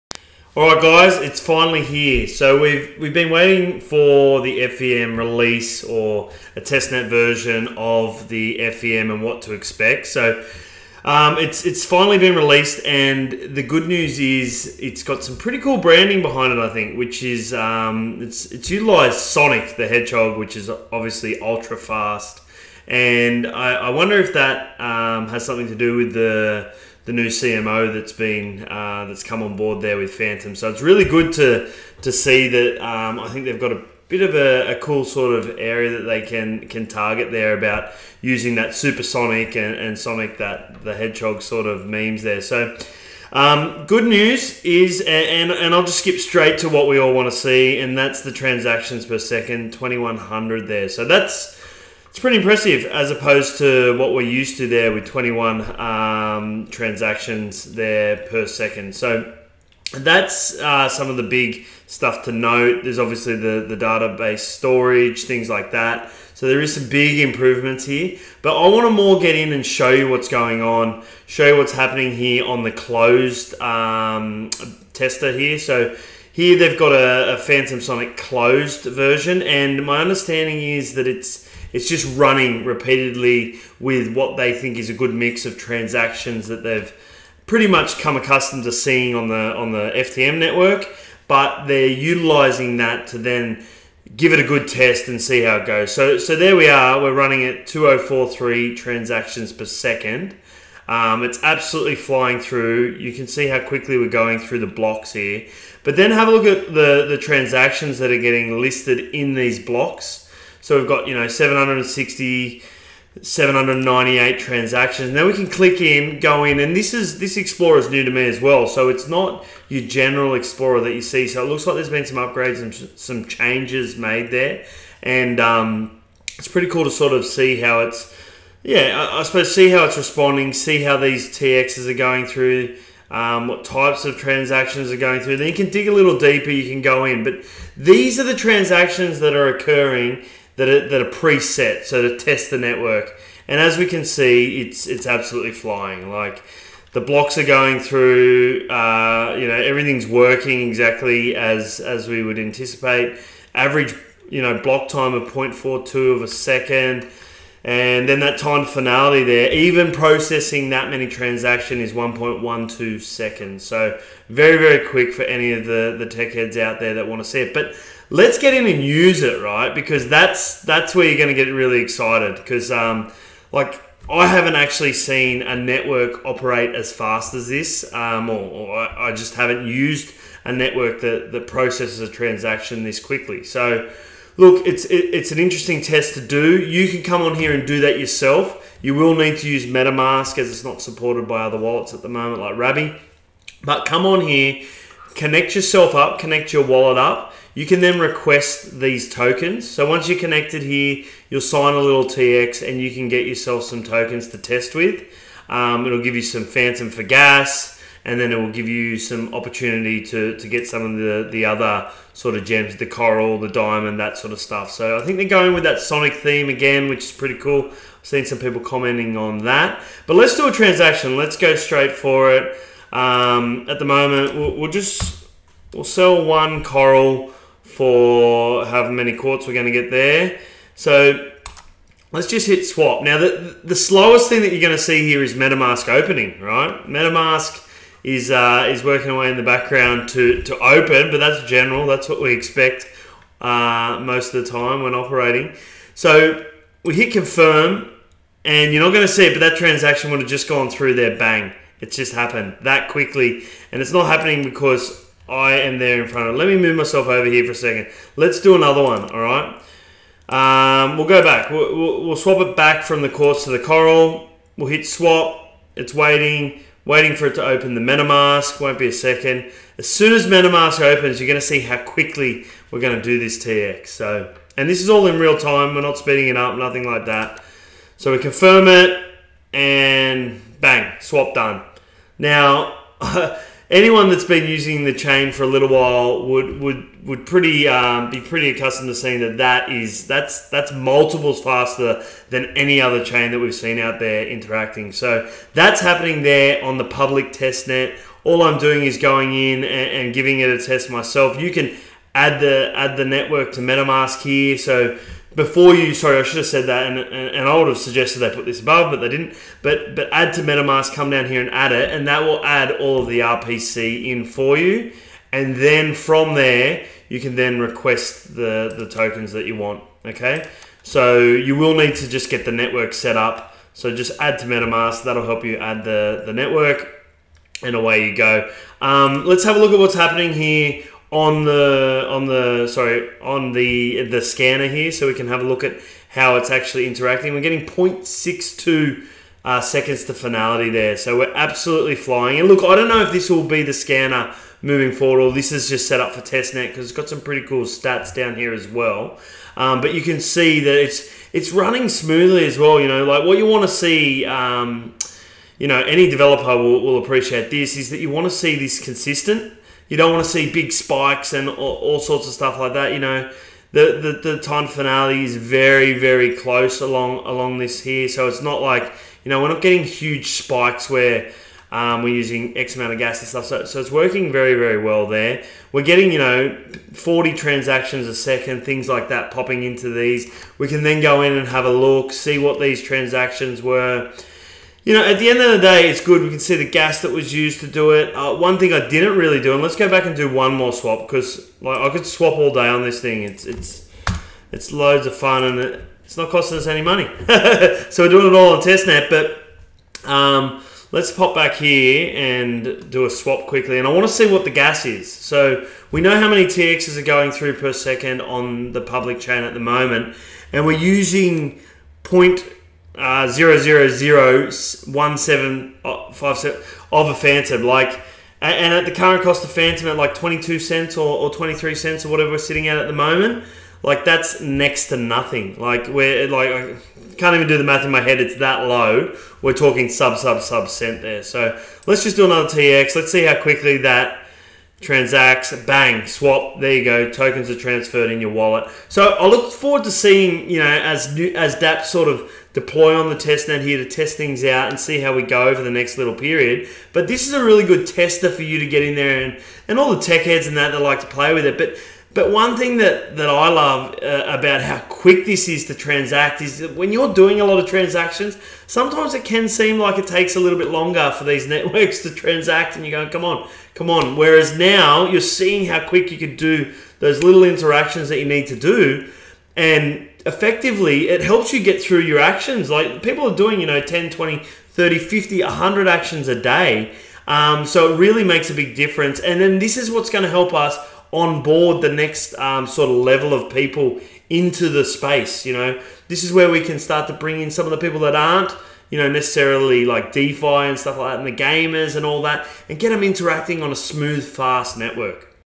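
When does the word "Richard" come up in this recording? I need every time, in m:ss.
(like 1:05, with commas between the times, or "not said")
not said.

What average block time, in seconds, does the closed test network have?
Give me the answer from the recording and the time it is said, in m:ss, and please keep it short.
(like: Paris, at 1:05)
0.42 seconds, at 2:35.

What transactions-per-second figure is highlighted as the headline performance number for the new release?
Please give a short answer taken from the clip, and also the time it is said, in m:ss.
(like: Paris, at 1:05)
2100, at 0:49.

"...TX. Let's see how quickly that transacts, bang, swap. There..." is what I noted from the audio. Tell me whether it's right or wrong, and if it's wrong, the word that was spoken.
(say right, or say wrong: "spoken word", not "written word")
right.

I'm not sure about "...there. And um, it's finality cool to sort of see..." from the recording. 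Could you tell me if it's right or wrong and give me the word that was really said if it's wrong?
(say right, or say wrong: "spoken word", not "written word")
wrong: "pretty", not "finality".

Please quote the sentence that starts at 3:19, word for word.
So once you're connected here, you'll sign a little TX and you can get yourself some tokens to test with.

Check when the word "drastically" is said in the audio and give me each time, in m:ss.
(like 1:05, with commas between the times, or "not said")
not said.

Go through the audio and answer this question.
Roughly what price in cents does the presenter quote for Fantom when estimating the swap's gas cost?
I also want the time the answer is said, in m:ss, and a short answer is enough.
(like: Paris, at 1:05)
22 cents, at 7:00.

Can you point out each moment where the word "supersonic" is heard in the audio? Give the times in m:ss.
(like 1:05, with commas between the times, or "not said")
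0:38.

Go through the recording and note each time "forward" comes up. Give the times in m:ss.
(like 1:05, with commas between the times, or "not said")
5:44, 7:19.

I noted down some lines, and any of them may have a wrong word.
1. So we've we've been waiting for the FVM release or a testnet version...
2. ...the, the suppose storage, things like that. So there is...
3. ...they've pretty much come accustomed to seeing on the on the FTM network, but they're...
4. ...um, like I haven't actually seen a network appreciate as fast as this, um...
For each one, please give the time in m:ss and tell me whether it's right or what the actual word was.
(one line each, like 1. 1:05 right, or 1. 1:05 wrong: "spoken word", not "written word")
1. 0:02 right
2. 1:03 wrong: "database", not "suppose"
3. 1:26 right
4. 2:52 wrong: "operate", not "appreciate".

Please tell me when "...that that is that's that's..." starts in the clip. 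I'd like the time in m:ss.
4:49.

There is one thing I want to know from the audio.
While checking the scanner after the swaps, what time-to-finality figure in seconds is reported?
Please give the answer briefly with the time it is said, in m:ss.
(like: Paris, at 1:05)
0.62 seconds, at 5:37.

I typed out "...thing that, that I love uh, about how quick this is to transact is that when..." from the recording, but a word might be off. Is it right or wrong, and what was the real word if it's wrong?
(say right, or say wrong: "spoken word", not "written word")
right.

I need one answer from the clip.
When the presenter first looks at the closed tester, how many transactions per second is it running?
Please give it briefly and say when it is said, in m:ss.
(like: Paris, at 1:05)
2043, at 1:37.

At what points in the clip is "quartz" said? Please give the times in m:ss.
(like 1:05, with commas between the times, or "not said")
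3:49, 4:23.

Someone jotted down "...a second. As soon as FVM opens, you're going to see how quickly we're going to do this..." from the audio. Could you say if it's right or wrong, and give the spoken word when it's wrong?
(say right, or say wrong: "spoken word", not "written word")
wrong: "MetaMask", not "FVM".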